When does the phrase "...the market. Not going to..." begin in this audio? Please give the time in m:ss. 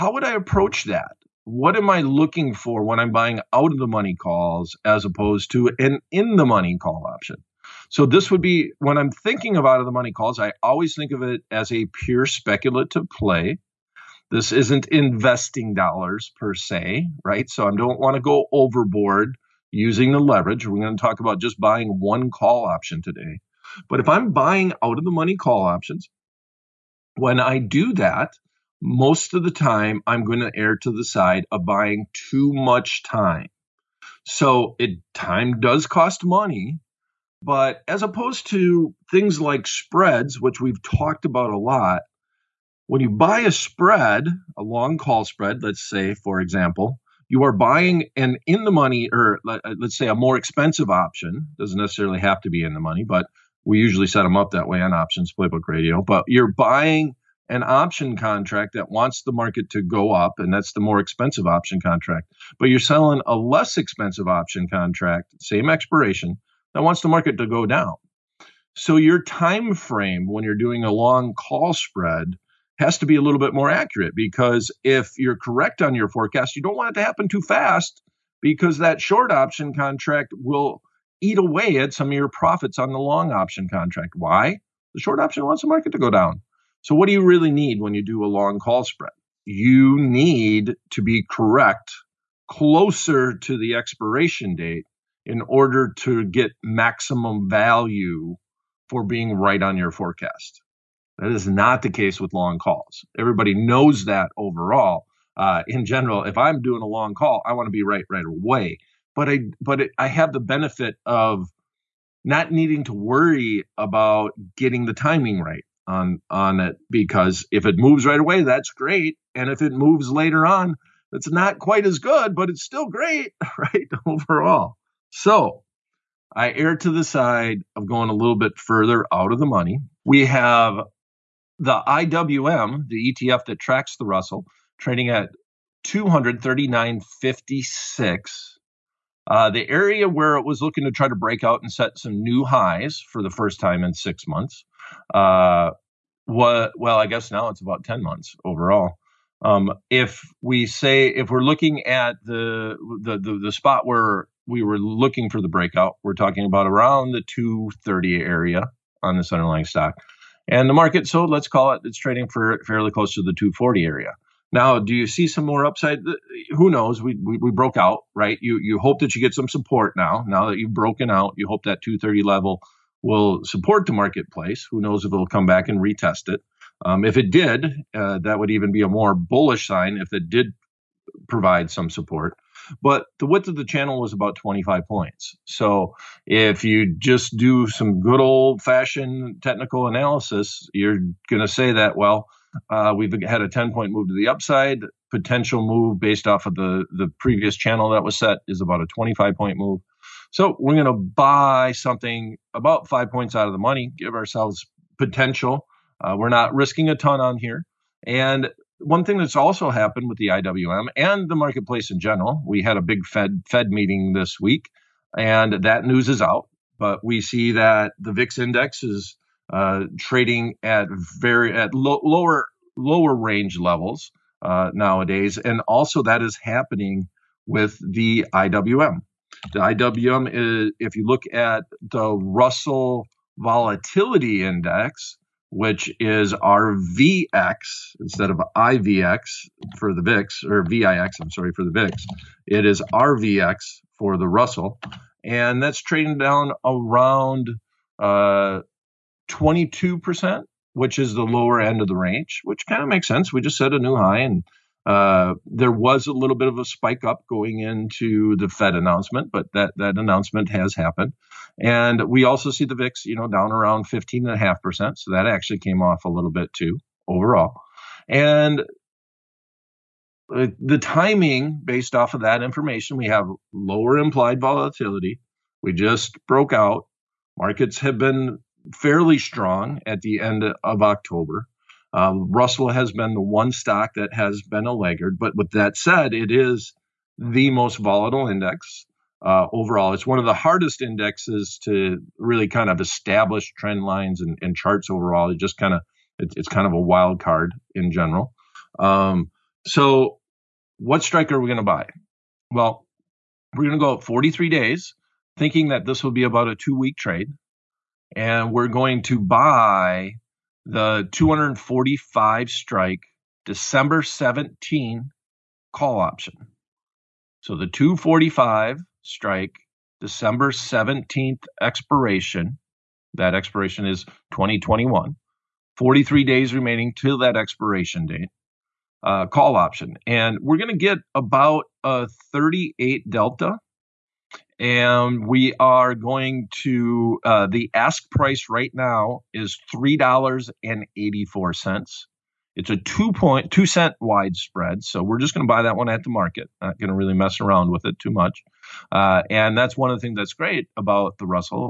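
5:46.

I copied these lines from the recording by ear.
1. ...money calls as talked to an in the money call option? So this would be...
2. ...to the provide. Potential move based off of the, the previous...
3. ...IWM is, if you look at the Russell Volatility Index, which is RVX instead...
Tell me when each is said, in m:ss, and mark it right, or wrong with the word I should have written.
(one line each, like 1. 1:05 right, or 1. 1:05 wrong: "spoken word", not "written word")
1. 0:03 wrong: "opposed", not "talked"
2. 3:14 wrong: "upside", not "provide"
3. 3:49 right.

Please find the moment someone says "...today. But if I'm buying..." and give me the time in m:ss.
0:23.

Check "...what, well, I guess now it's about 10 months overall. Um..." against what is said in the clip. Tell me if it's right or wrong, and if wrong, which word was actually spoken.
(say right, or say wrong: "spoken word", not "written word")
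right.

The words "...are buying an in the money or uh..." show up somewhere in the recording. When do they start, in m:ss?
0:47.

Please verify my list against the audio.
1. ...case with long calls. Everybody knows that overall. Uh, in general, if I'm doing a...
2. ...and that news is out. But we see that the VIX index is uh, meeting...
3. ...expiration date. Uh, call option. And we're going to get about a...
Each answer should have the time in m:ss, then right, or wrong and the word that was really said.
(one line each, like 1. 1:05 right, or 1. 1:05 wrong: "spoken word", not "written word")
1. 1:41 right
2. 3:35 wrong: "trading", not "meeting"
3. 5:27 right.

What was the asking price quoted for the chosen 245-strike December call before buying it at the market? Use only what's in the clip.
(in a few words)
$3.84.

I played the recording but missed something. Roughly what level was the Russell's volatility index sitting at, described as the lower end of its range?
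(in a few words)
22%.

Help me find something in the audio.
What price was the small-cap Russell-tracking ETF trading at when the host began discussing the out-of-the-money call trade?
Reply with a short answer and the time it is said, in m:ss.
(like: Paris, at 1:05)
239.56, at 2:15.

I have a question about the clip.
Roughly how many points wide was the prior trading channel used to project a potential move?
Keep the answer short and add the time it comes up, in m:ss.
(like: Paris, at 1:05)
25 points, at 3:04.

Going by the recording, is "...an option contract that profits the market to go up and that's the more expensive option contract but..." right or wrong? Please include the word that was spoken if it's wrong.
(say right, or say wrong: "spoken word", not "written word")
wrong: "wants", not "profits".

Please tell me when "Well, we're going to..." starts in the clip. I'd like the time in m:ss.
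5:02.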